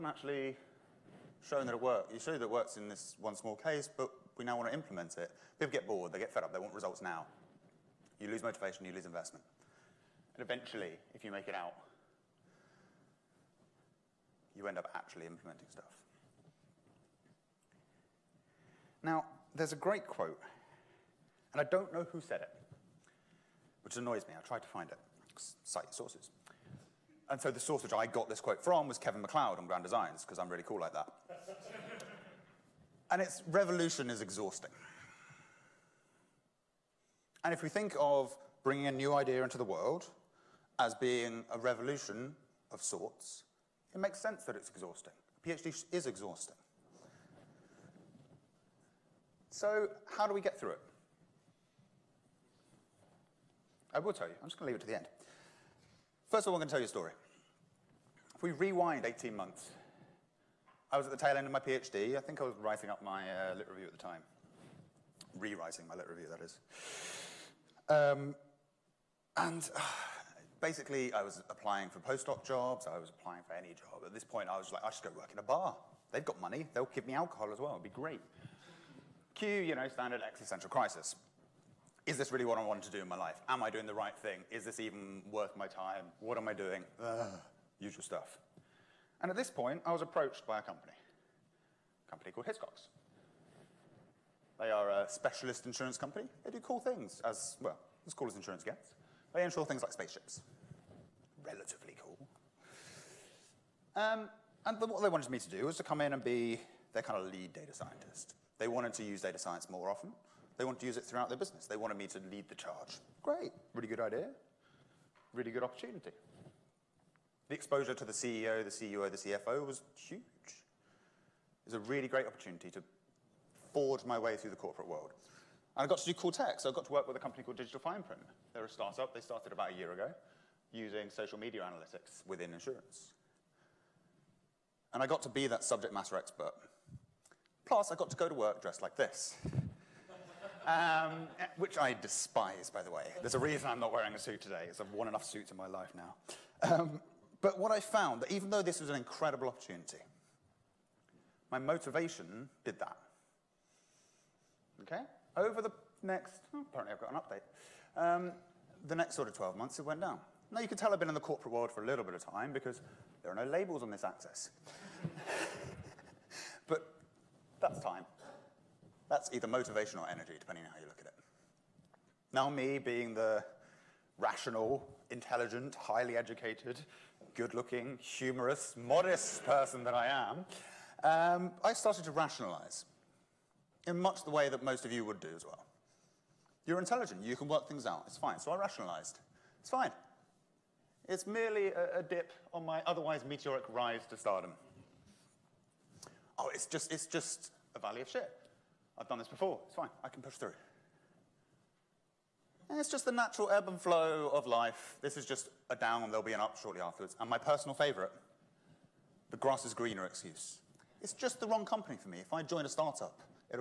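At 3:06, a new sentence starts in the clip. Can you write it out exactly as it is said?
You're intelligent, you can work things out, it's fine.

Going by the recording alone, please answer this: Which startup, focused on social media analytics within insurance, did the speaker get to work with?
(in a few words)
Digital Fine Print.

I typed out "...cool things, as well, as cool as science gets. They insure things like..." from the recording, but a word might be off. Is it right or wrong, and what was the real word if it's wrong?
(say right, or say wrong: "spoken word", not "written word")
wrong: "insurance", not "science".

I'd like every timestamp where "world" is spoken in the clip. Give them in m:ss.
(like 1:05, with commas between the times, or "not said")
0:39, 2:04, 2:41.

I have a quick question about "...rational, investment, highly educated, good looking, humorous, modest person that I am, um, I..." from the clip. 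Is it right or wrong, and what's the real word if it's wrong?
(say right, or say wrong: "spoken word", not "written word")
wrong: "intelligent", not "investment".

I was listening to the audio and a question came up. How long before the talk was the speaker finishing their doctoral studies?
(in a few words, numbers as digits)
18 months.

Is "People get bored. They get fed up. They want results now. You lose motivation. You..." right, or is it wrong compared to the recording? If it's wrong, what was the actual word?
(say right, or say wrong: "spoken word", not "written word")
right.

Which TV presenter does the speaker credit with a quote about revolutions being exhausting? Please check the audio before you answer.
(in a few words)
Kevin McCloud.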